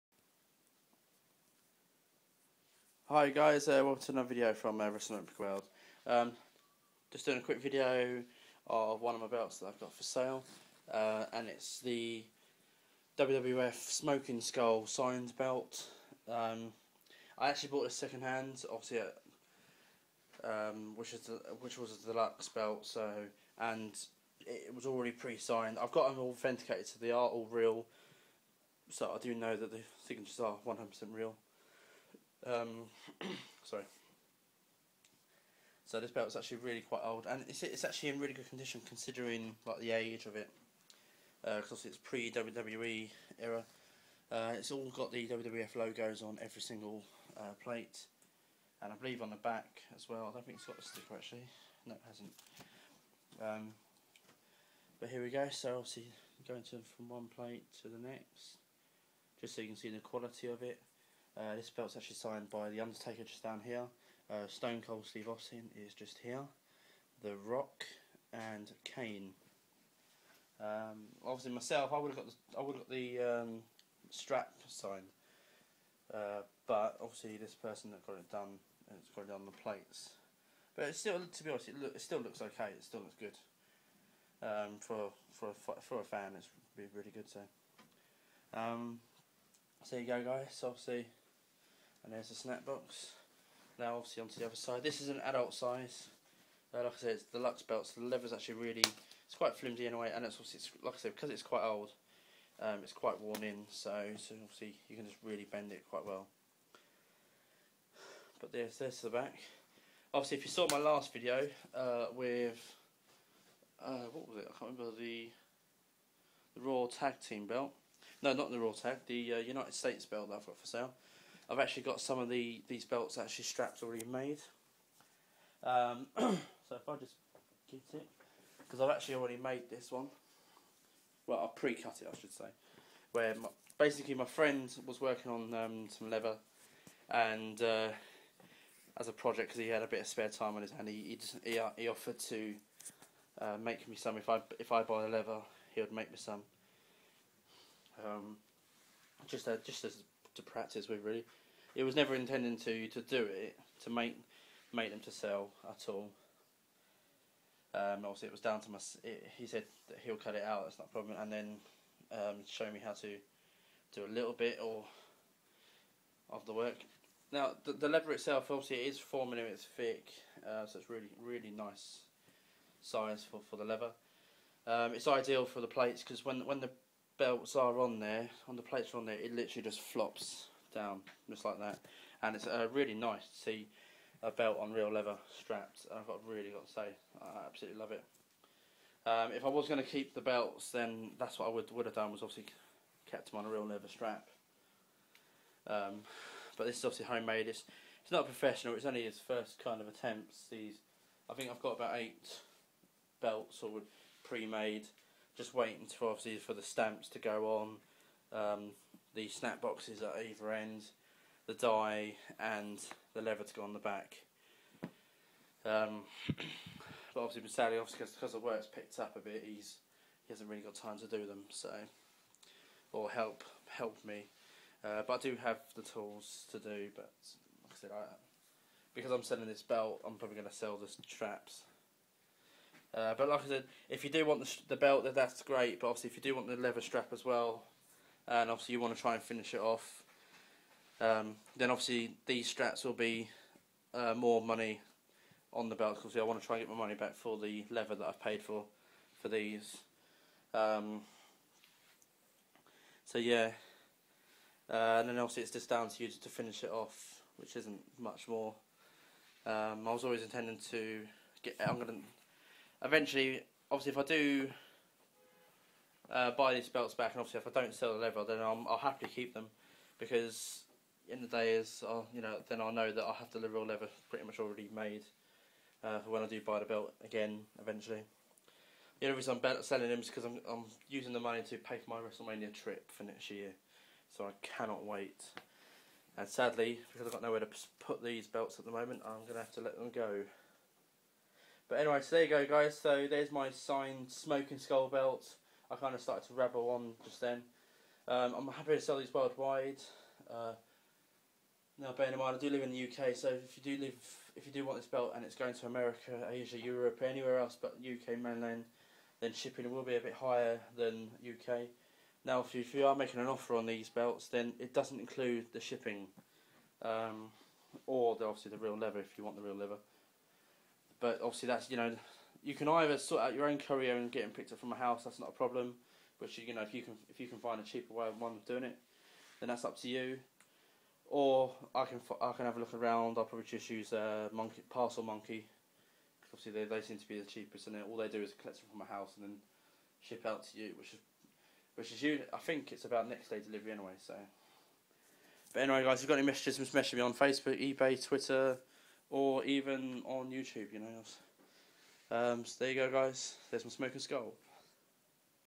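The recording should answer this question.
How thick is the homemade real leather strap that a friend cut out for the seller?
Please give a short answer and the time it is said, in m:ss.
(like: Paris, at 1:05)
4 millimeters, at 2:48.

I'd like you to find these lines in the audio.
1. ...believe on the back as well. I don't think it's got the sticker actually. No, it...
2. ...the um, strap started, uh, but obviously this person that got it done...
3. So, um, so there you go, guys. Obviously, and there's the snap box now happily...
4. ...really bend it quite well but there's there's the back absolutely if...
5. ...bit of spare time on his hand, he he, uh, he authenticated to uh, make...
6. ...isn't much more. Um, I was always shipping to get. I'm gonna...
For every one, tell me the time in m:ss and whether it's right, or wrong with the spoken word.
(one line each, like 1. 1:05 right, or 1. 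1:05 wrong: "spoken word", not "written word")
1. 0:48 right
2. 1:12 wrong: "signed", not "started"
3. 1:27 wrong: "obviously", not "happily"
4. 1:45 wrong: "obviously", not "absolutely"
5. 2:19 wrong: "offered", not "authenticated"
6. 4:17 wrong: "intending", not "shipping".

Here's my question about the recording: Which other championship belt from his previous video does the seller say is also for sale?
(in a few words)
United States belt.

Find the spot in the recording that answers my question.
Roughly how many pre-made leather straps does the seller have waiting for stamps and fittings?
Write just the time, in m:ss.
3:21.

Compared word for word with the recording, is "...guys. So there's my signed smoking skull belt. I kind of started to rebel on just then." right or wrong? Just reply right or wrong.
right.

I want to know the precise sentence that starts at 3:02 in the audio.
And it's uh, really nice to see a belt on real leather strapped.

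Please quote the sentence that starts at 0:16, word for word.
Um, I actually bought this second hand, obviously, at, um, which is the, which was the deluxe belt.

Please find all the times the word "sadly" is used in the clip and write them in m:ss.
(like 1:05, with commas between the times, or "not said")
3:37, 4:46.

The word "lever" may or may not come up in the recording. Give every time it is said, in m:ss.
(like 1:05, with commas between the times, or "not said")
2:53, 3:33.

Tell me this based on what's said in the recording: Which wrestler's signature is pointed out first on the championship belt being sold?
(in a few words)
The Undertaker.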